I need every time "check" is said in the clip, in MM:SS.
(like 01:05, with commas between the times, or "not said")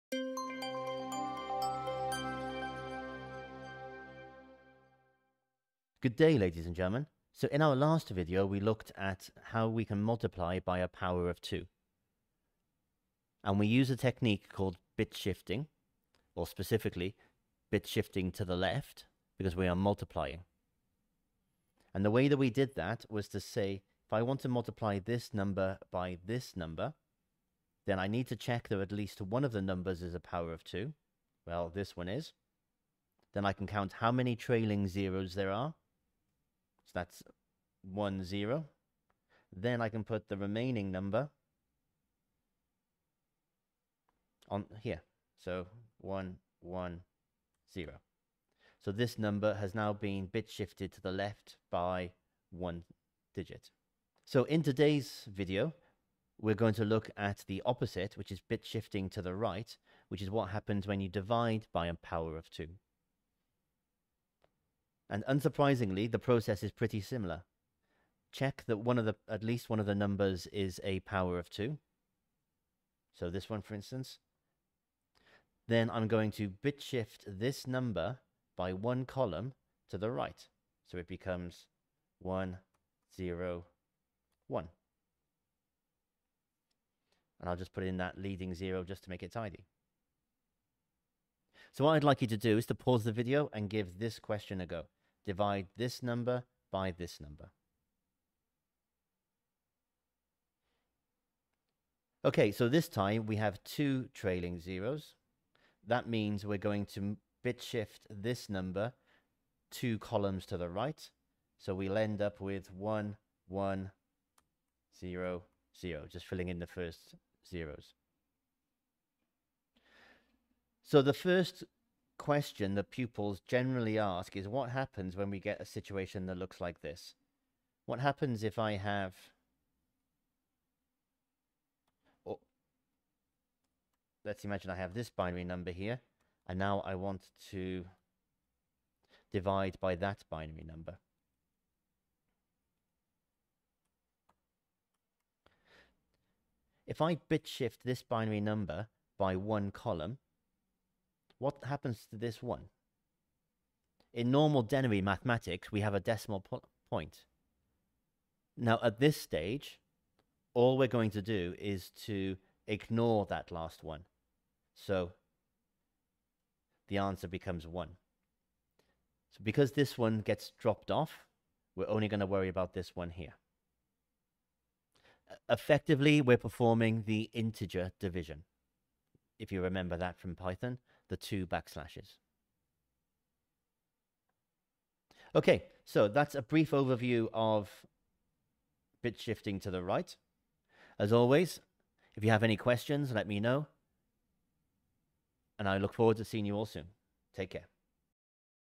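00:28, 01:08.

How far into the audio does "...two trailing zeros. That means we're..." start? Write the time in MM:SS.
01:43.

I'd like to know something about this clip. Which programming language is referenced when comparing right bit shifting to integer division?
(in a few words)
Python.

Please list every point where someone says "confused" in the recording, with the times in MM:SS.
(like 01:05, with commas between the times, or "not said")
not said.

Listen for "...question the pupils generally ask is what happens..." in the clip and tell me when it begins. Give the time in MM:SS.
02:02.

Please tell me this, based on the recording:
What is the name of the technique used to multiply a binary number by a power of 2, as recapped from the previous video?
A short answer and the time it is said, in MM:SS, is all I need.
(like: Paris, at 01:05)
bit shifting to the left, at 00:17.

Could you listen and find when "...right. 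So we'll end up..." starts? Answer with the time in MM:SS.
01:50.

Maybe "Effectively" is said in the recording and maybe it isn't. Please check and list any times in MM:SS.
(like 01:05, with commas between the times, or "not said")
02:55.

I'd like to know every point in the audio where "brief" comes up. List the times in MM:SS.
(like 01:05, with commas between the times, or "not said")
03:06.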